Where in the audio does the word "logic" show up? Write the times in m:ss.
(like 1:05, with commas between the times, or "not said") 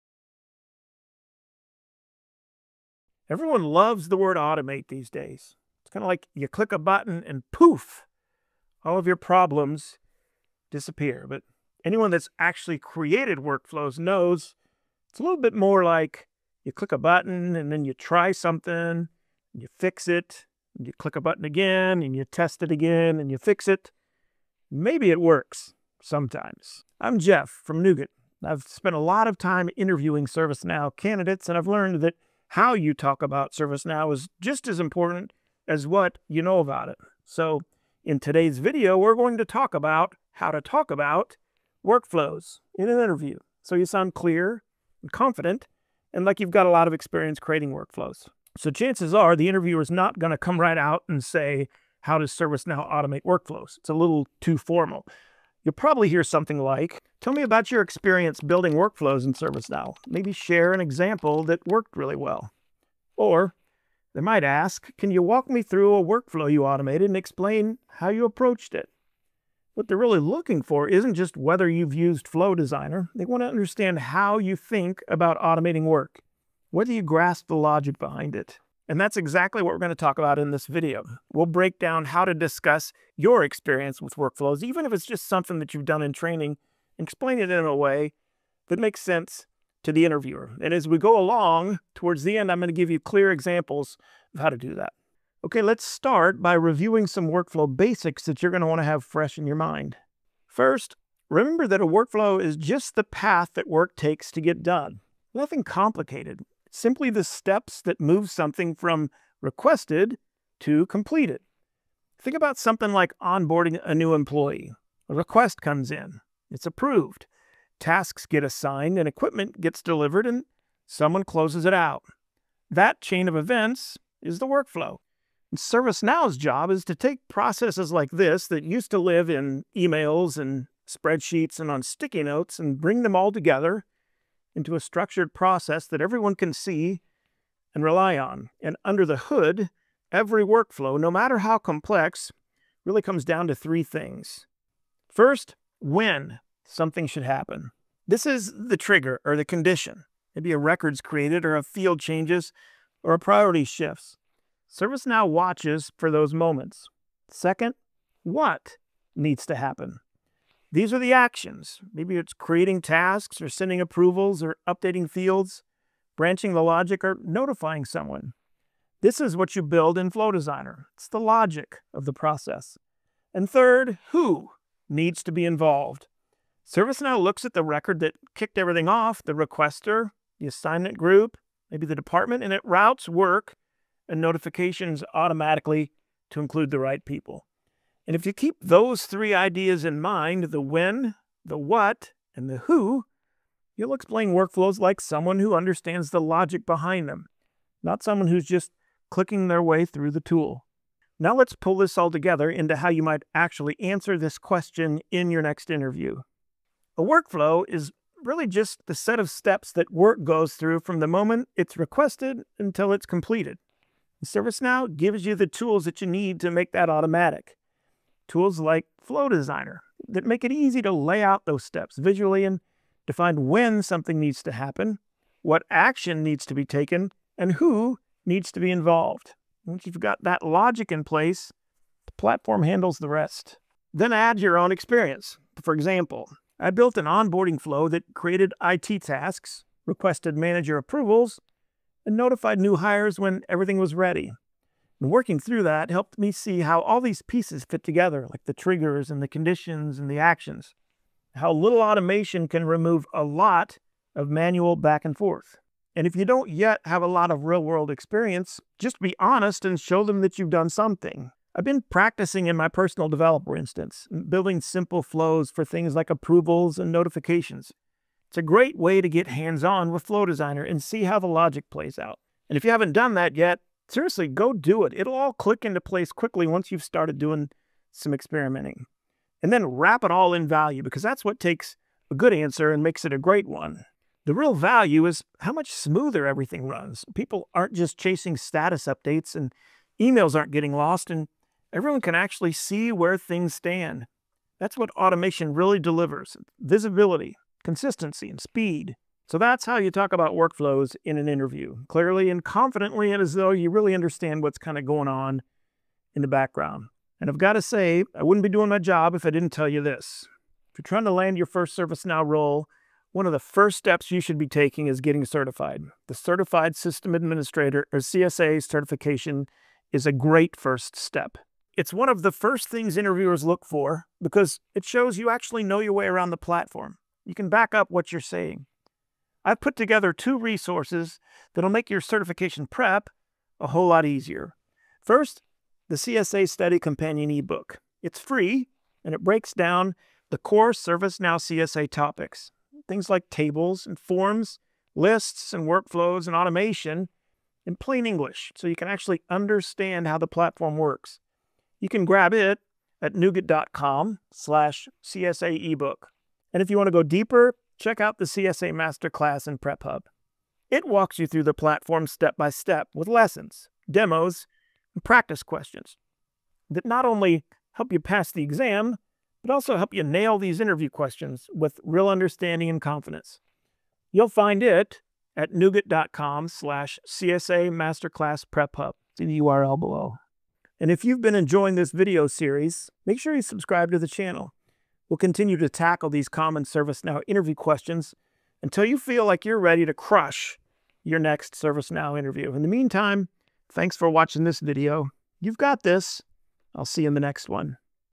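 1:17, 2:46, 2:51, 3:16, 3:50, 4:31.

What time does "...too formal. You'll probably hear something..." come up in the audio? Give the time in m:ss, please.
0:54.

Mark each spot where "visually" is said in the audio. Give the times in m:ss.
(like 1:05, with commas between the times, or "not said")
3:41.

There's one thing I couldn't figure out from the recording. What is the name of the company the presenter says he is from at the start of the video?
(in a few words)
Knewget.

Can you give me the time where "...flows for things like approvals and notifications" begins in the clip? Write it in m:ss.
4:25.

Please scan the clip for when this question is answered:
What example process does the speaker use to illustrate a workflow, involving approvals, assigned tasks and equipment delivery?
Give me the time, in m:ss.
1:53.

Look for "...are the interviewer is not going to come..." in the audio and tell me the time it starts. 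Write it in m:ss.
0:49.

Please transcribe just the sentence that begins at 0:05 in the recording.
It's kind of like you click a button and poof, all of your problems disappear.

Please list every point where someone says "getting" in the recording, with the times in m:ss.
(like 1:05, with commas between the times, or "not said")
4:50, 5:14.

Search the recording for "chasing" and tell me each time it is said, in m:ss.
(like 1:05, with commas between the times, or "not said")
4:47.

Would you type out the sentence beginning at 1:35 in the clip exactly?
Okay, let's start by reviewing some workflow basics that you're going to want to have fresh in your mind.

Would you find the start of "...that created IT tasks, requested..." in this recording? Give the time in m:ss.
3:57.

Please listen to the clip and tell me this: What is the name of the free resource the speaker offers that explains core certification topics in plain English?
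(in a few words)
CSA Study Companion eBook.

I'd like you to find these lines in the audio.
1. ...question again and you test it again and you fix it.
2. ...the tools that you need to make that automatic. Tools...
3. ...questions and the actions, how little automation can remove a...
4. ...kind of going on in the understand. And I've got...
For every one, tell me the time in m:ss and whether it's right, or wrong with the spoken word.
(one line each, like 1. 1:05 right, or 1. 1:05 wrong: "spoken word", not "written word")
1. 0:21 wrong: "button", not "question"
2. 3:35 right
3. 4:09 wrong: "conditions", not "questions"
4. 5:04 wrong: "background", not "understand".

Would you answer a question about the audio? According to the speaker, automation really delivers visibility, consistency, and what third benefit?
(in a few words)
Speed.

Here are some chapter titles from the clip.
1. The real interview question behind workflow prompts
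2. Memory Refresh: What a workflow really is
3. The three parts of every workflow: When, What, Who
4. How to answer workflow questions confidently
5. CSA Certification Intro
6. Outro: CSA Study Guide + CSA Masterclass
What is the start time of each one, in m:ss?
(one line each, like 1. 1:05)
1. 0:48
2. 1:35
3. 2:25
4. 3:21
5. 5:07
6. 5:28.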